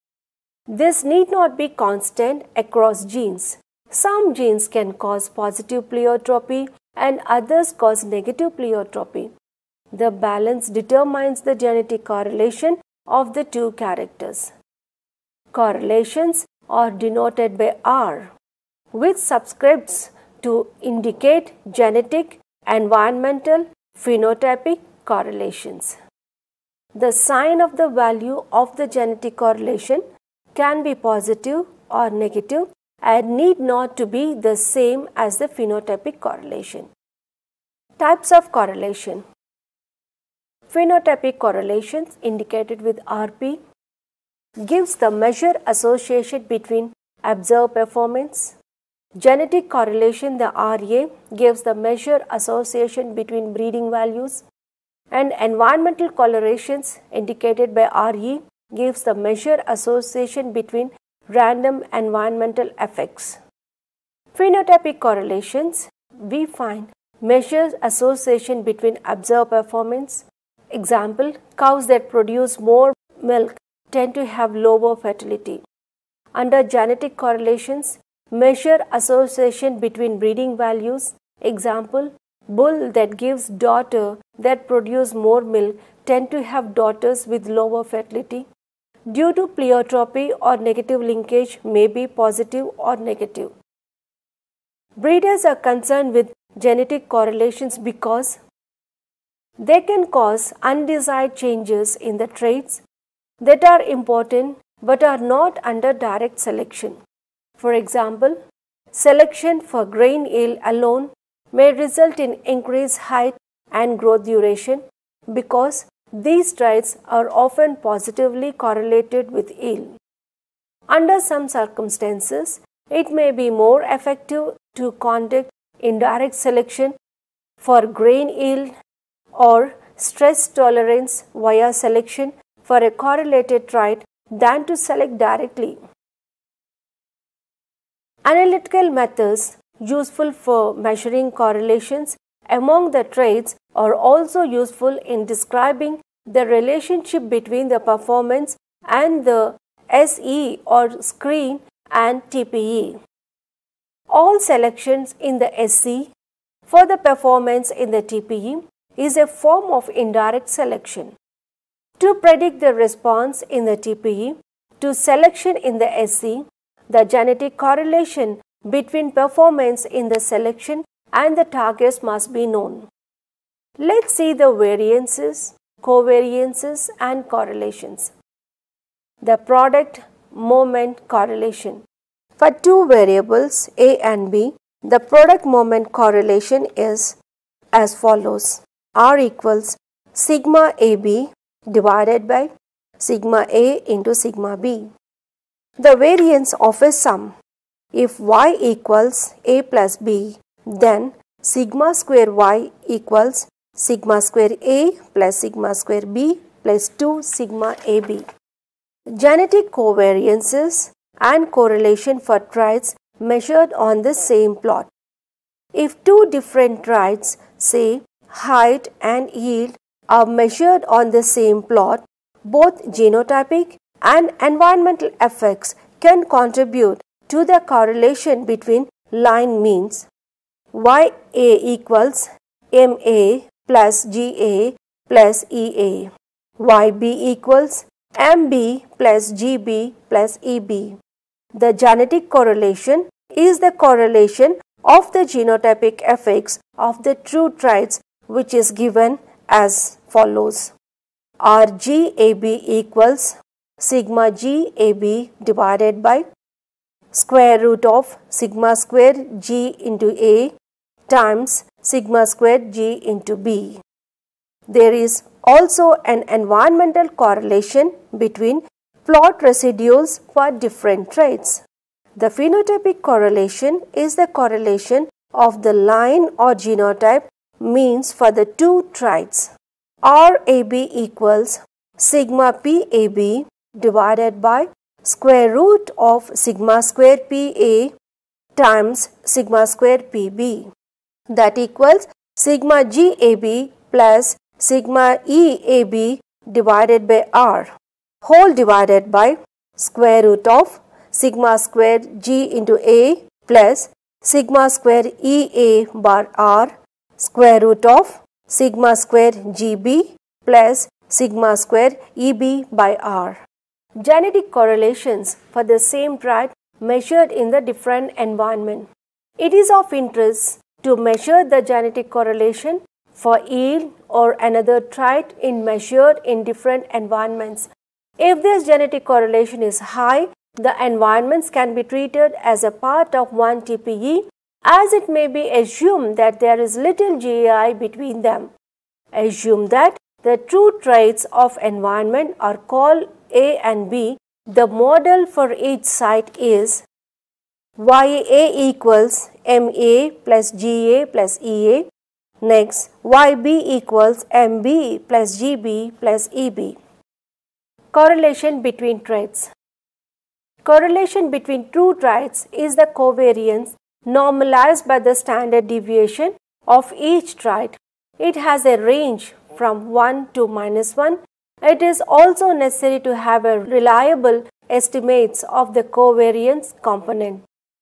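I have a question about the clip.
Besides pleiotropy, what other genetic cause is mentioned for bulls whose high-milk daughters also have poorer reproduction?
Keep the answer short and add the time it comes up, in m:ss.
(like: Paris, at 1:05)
negative linkage, at 1:30.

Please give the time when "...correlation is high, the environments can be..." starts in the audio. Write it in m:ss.
5:29.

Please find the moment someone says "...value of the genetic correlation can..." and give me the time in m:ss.
0:27.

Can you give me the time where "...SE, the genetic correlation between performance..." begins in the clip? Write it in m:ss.
2:46.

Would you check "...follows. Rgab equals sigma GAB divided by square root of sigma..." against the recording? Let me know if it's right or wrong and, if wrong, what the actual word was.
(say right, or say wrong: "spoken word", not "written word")
right.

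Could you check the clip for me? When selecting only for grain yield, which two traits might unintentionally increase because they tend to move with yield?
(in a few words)
height and growth duration.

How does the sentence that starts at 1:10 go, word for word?
Example, cows that produce more milk tend to have lower fertility.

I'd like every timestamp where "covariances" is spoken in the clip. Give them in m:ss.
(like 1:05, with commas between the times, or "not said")
2:55, 3:29, 6:02, 6:15.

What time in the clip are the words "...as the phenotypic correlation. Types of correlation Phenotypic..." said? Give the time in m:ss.
0:35.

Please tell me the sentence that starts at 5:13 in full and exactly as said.
Genetic correlations for the same trait measured in the different environment.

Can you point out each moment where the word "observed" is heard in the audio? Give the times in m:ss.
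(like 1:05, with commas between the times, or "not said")
0:47, 1:09.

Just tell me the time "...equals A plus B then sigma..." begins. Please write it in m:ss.
3:18.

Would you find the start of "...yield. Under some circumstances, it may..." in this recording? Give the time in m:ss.
1:59.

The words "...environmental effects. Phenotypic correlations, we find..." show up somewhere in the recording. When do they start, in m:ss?
1:01.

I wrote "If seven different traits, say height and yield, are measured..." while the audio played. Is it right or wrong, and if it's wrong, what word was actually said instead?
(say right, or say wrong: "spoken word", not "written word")
wrong: "two", not "seven".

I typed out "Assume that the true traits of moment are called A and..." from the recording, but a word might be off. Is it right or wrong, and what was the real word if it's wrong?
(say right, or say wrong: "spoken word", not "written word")
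wrong: "environment", not "moment".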